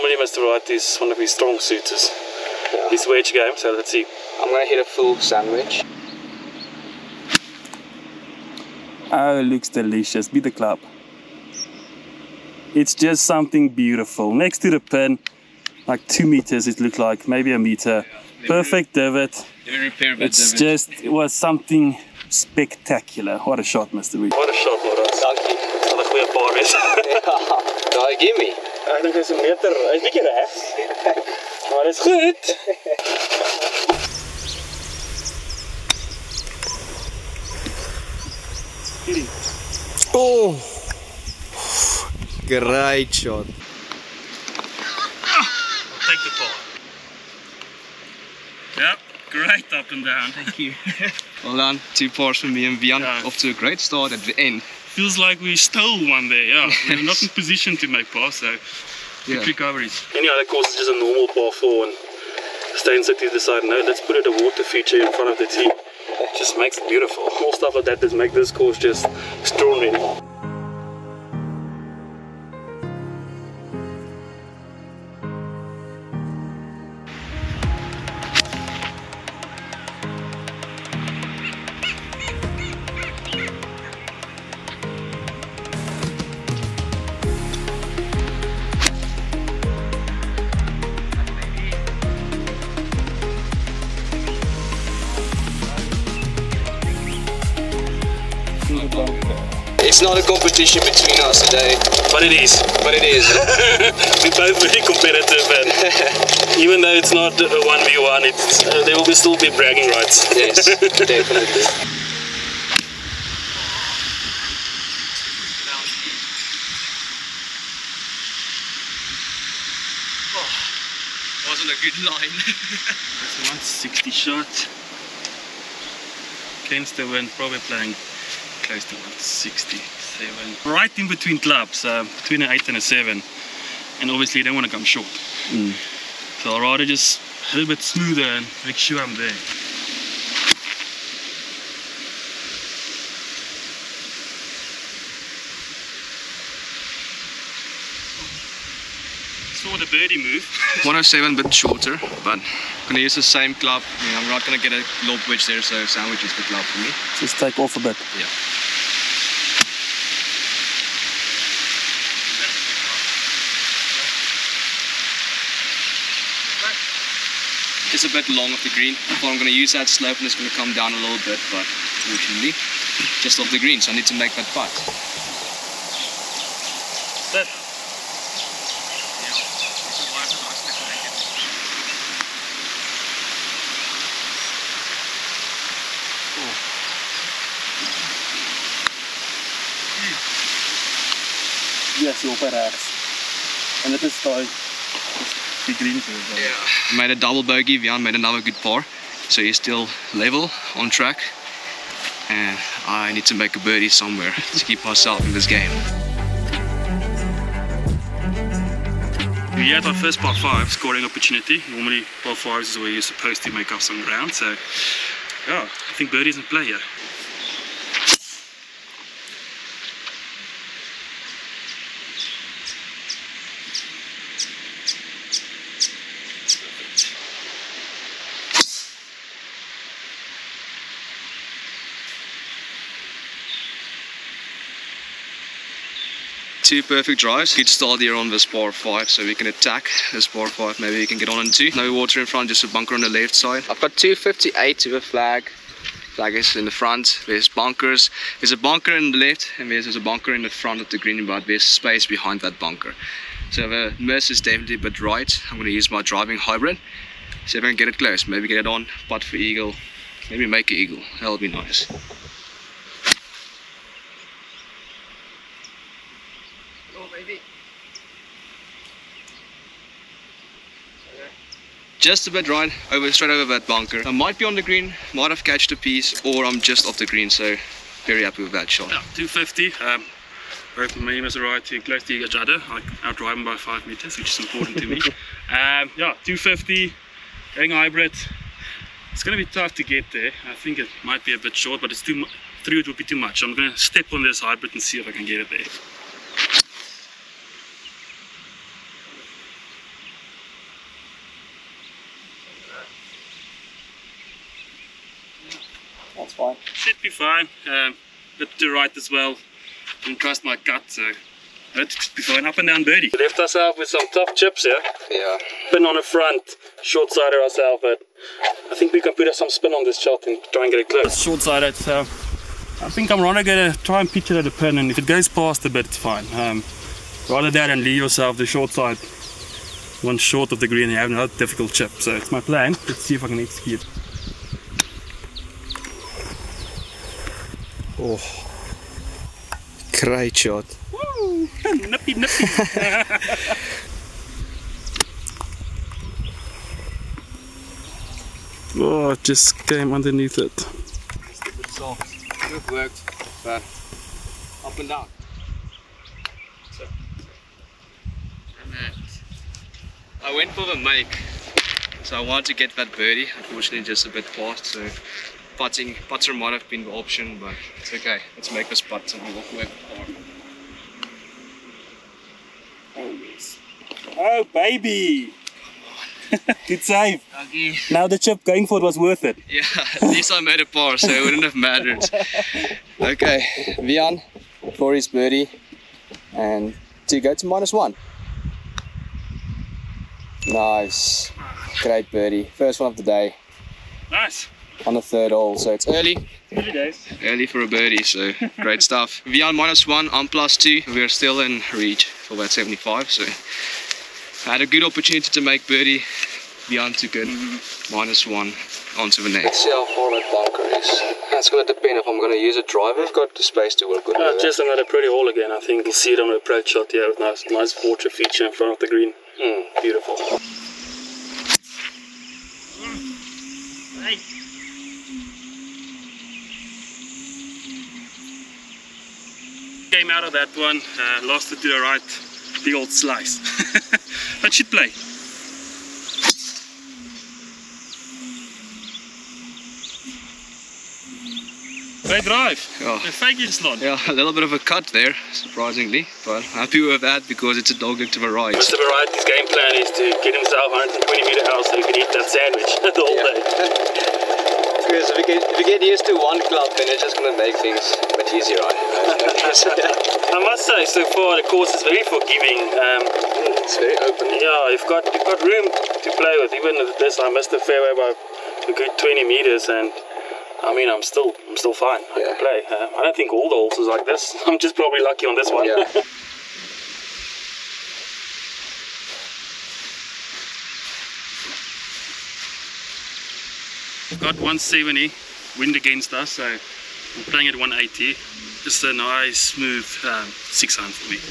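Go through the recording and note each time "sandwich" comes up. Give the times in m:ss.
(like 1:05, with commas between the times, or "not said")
0:05, 2:35, 7:32.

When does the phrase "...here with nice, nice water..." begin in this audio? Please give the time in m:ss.
6:56.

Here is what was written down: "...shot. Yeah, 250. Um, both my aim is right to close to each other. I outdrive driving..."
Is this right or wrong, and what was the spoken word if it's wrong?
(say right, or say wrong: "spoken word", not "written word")
right.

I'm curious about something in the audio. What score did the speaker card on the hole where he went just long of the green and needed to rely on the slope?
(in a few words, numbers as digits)
Double bogey.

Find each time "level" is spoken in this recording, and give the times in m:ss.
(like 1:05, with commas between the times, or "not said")
3:20.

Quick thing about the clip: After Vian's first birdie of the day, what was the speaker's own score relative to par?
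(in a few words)
Plus two.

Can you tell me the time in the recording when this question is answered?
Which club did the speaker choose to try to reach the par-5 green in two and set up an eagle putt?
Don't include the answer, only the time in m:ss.
4:16.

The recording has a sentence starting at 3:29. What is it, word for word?
We had our first par 5 scoring opportunity.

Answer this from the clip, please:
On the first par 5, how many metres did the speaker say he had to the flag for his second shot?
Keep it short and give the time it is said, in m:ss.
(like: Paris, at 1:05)
258, at 4:03.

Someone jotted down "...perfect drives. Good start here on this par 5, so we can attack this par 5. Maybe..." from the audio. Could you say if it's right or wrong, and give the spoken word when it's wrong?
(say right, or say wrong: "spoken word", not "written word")
right.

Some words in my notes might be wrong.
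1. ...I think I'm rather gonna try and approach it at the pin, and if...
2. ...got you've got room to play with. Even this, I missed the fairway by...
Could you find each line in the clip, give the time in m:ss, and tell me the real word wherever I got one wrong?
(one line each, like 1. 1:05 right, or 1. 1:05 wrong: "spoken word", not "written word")
1. 5:22 wrong: "pitch", not "approach"
2. 7:44 right.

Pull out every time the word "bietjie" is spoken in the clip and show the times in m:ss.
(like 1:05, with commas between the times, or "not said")
0:30.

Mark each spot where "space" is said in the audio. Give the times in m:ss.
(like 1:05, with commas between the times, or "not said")
4:11, 6:53.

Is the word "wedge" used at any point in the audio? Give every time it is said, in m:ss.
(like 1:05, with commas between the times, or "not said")
0:03, 2:35.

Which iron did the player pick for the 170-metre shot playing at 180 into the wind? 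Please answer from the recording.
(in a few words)
Six iron.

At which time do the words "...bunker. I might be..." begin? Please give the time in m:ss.
4:33.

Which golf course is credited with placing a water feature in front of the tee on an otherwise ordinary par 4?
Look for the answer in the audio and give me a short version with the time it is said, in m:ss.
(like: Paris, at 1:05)
Steyn City, at 1:02.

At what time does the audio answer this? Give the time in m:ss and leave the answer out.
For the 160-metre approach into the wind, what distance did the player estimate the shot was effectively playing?
2:08.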